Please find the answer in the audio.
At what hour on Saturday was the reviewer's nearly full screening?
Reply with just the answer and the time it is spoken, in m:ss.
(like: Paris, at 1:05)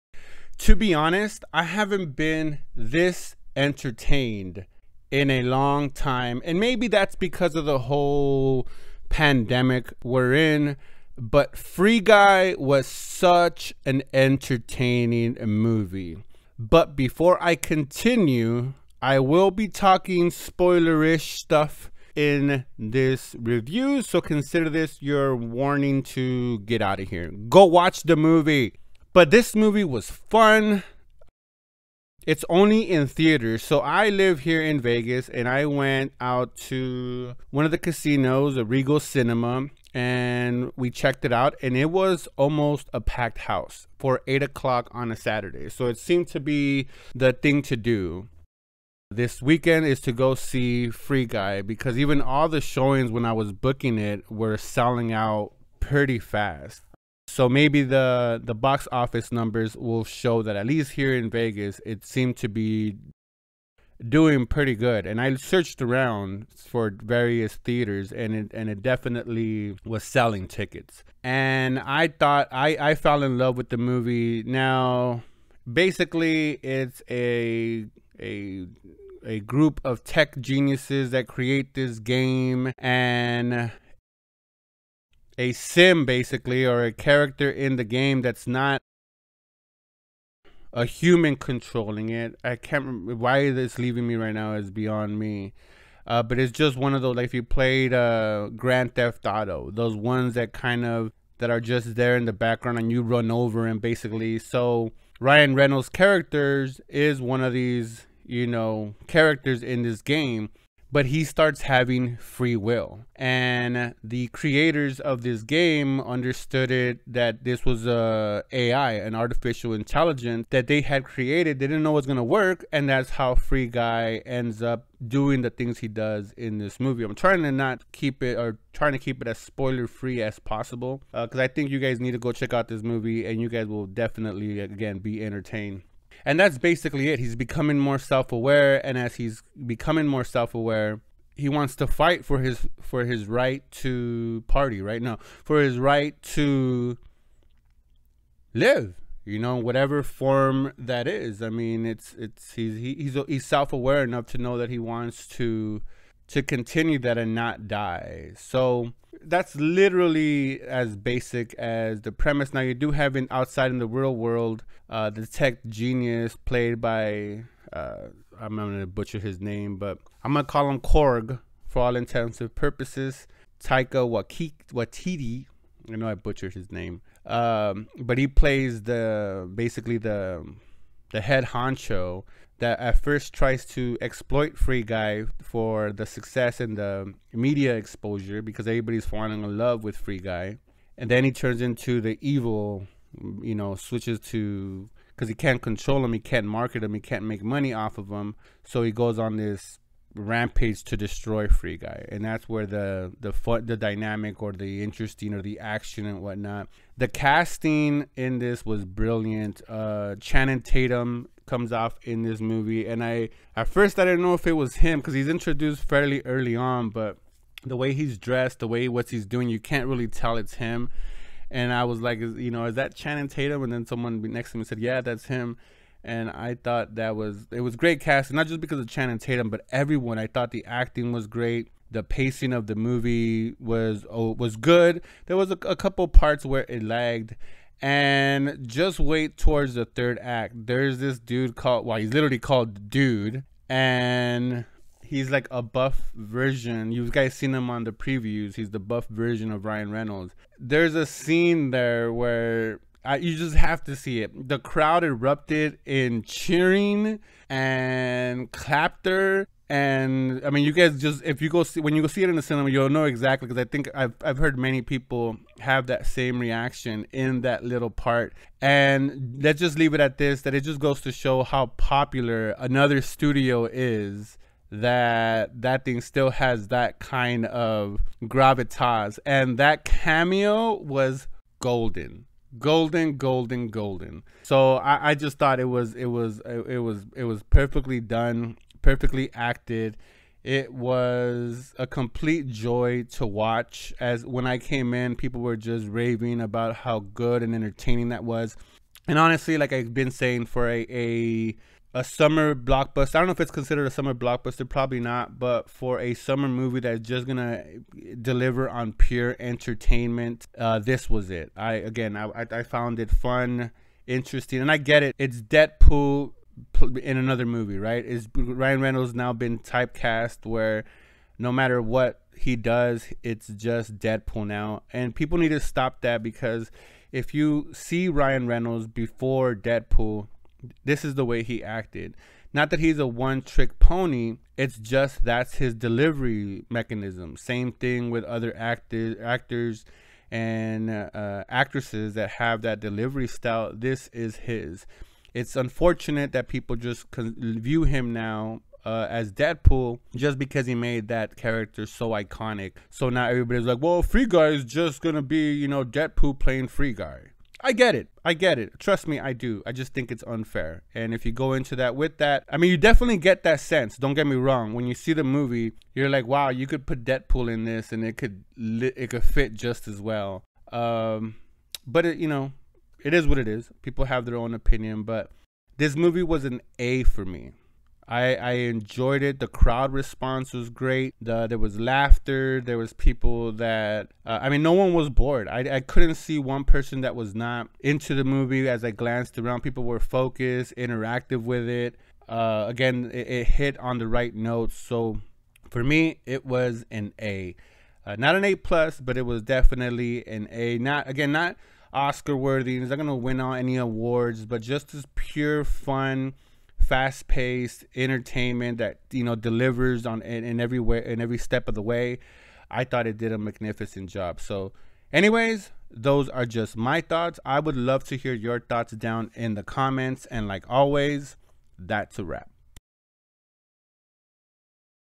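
8 o'clock, at 0:44.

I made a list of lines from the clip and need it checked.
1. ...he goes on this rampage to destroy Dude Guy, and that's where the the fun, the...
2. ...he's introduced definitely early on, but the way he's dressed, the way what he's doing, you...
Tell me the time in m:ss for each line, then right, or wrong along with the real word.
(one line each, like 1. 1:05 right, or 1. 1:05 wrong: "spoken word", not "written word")
1. 3:18 wrong: "Free", not "Dude"
2. 3:35 wrong: "fairly", not "definitely".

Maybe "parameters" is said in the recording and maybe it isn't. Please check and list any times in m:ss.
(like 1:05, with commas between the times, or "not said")
not said.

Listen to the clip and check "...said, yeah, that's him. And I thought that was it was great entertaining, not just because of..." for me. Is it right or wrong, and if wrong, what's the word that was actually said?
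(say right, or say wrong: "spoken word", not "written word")
wrong: "casting", not "entertaining".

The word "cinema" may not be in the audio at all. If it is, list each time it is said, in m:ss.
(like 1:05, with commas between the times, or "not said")
0:39, 4:22.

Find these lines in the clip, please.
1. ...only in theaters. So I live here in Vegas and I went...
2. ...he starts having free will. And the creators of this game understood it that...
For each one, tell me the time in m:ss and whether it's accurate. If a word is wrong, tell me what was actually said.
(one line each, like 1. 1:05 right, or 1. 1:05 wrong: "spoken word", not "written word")
1. 0:32 right
2. 1:51 right.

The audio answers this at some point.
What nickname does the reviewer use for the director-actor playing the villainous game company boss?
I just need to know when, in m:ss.
2:50.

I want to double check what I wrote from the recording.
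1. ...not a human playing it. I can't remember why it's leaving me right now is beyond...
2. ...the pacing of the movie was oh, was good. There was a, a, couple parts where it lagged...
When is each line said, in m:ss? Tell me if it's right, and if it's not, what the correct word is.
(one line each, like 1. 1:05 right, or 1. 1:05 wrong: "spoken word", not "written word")
1. 1:28 wrong: "controlling", not "playing"
2. 3:51 right.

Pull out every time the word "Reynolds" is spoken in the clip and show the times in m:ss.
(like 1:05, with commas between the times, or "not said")
1:45, 4:09, 5:18, 5:28.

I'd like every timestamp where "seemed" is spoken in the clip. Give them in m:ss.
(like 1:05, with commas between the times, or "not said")
0:45, 1:02.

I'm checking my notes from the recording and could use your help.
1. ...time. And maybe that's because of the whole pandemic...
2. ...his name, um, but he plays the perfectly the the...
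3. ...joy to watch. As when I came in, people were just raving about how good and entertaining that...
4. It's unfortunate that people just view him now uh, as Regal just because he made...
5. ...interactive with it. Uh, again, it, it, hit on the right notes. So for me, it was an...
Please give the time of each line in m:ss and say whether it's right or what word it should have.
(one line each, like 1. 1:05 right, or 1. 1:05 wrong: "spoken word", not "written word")
1. 0:05 right
2. 2:56 wrong: "basically", not "perfectly"
3. 4:52 right
4. 5:45 wrong: "Deadpool", not "Regal"
5. 6:30 right.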